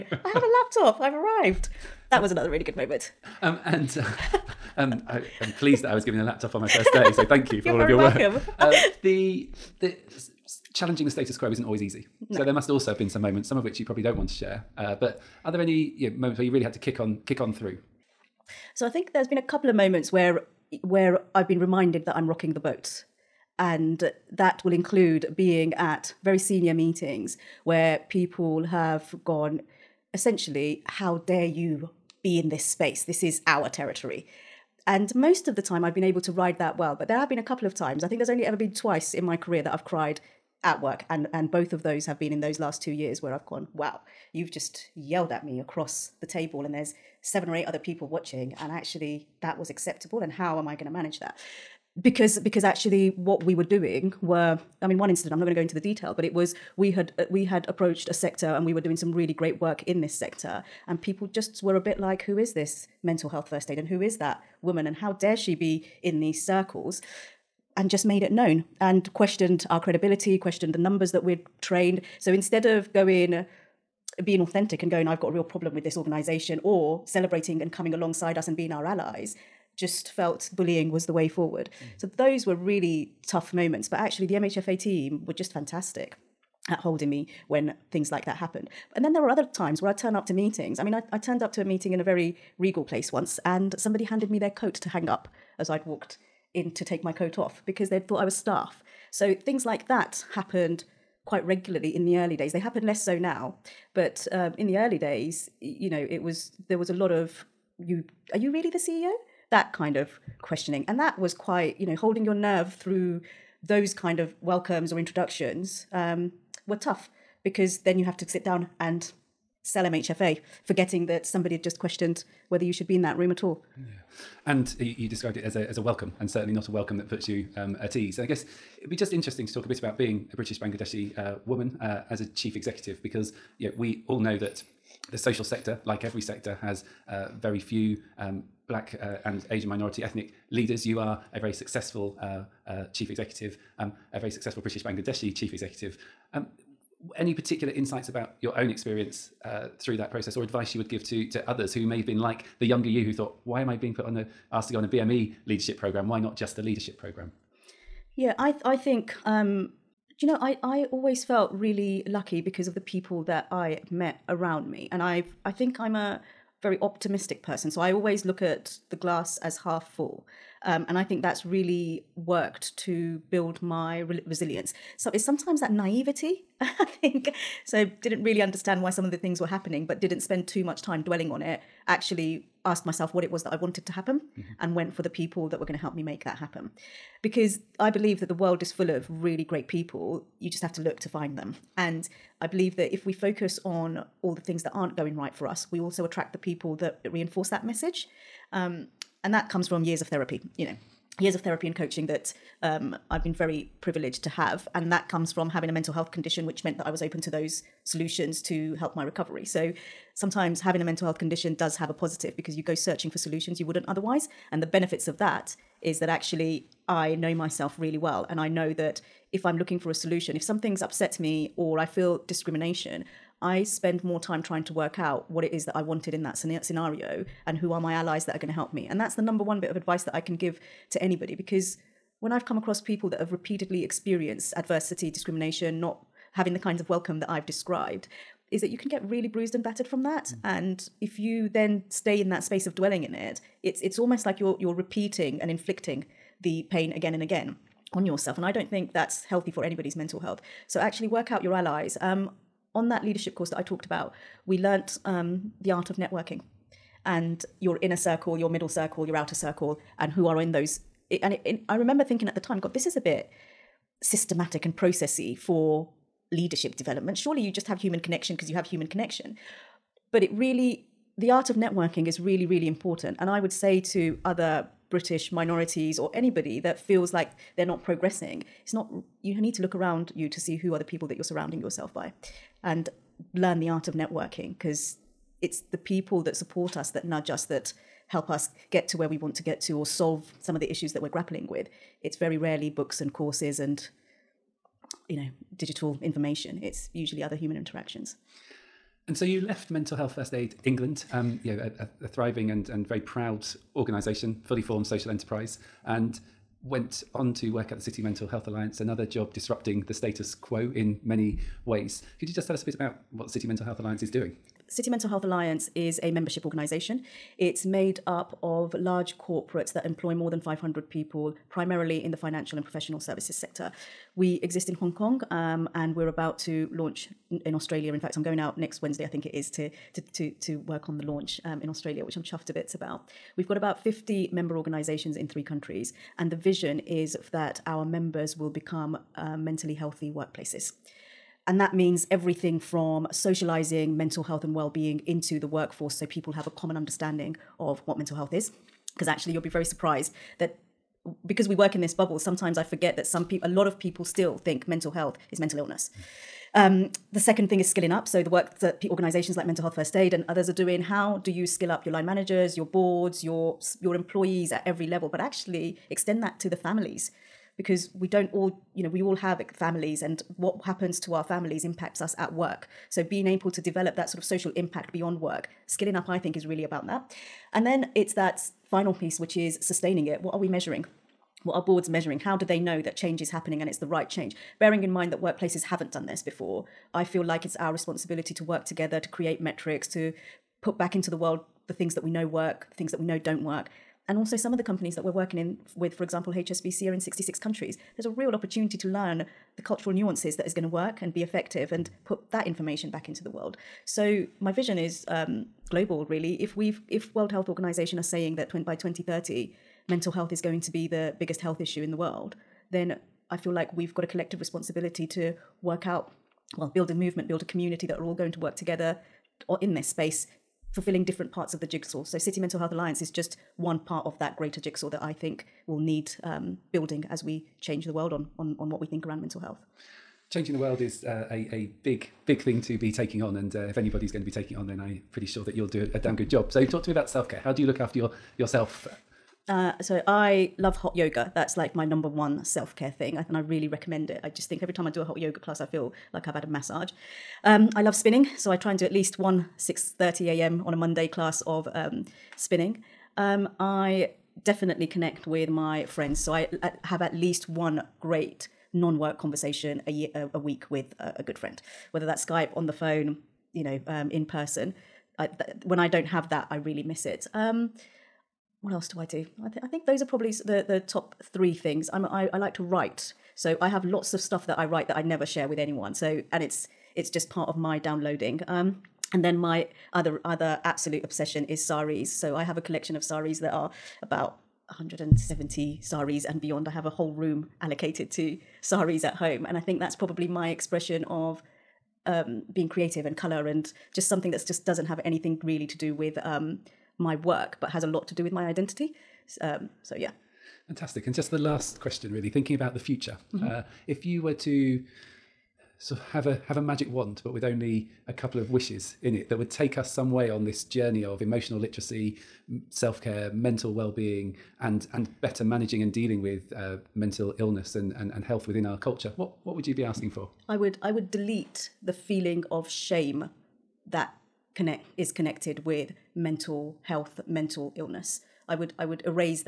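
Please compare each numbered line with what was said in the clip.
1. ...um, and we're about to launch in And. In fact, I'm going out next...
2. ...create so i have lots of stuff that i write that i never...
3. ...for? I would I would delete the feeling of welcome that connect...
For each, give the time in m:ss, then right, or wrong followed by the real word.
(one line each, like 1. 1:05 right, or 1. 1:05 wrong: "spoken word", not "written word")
1. 5:25 wrong: "Australia", not "And"
2. 7:52 wrong: "write", not "create"
3. 8:40 wrong: "shame", not "welcome".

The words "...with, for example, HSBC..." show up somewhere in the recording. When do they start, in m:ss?
6:35.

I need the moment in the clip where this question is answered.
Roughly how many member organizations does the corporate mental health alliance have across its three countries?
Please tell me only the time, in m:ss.
5:33.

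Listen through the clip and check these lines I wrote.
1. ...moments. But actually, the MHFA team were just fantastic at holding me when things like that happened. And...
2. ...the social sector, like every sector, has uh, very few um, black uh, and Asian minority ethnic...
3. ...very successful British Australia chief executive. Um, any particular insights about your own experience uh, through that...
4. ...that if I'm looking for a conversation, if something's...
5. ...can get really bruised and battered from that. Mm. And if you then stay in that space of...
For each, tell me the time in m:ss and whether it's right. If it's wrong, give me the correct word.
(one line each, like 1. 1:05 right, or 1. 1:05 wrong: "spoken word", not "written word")
1. 1:23 right
2. 2:15 right
3. 2:24 wrong: "Bangladeshi", not "Australia"
4. 3:38 wrong: "solution", not "conversation"
5. 3:58 right.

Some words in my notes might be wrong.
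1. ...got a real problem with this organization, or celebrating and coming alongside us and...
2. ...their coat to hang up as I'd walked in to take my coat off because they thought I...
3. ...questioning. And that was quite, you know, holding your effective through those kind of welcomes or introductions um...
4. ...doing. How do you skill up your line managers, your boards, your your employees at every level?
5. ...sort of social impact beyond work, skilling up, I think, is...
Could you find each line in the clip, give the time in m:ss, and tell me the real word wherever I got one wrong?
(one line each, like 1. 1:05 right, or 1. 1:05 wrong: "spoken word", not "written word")
1. 1:15 right
2. 1:34 right
3. 1:50 wrong: "nerve", not "effective"
4. 6:00 right
5. 6:14 right.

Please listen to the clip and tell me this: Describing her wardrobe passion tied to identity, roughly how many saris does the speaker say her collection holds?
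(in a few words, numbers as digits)
170.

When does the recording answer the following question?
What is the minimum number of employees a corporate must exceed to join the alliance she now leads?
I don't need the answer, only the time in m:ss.
5:20.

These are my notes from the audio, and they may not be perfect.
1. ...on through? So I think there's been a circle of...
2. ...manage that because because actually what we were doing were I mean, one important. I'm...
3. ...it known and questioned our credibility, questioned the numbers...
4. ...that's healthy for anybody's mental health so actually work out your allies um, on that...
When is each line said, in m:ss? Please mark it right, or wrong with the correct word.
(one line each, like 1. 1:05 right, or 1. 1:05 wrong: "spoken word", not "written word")
1. 0:17 wrong: "couple", not "circle"
2. 0:50 wrong: "incident", not "important"
3. 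1:08 right
4. 4:08 right.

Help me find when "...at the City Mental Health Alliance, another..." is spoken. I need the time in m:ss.
5:07.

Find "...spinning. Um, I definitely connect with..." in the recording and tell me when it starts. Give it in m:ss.
7:32.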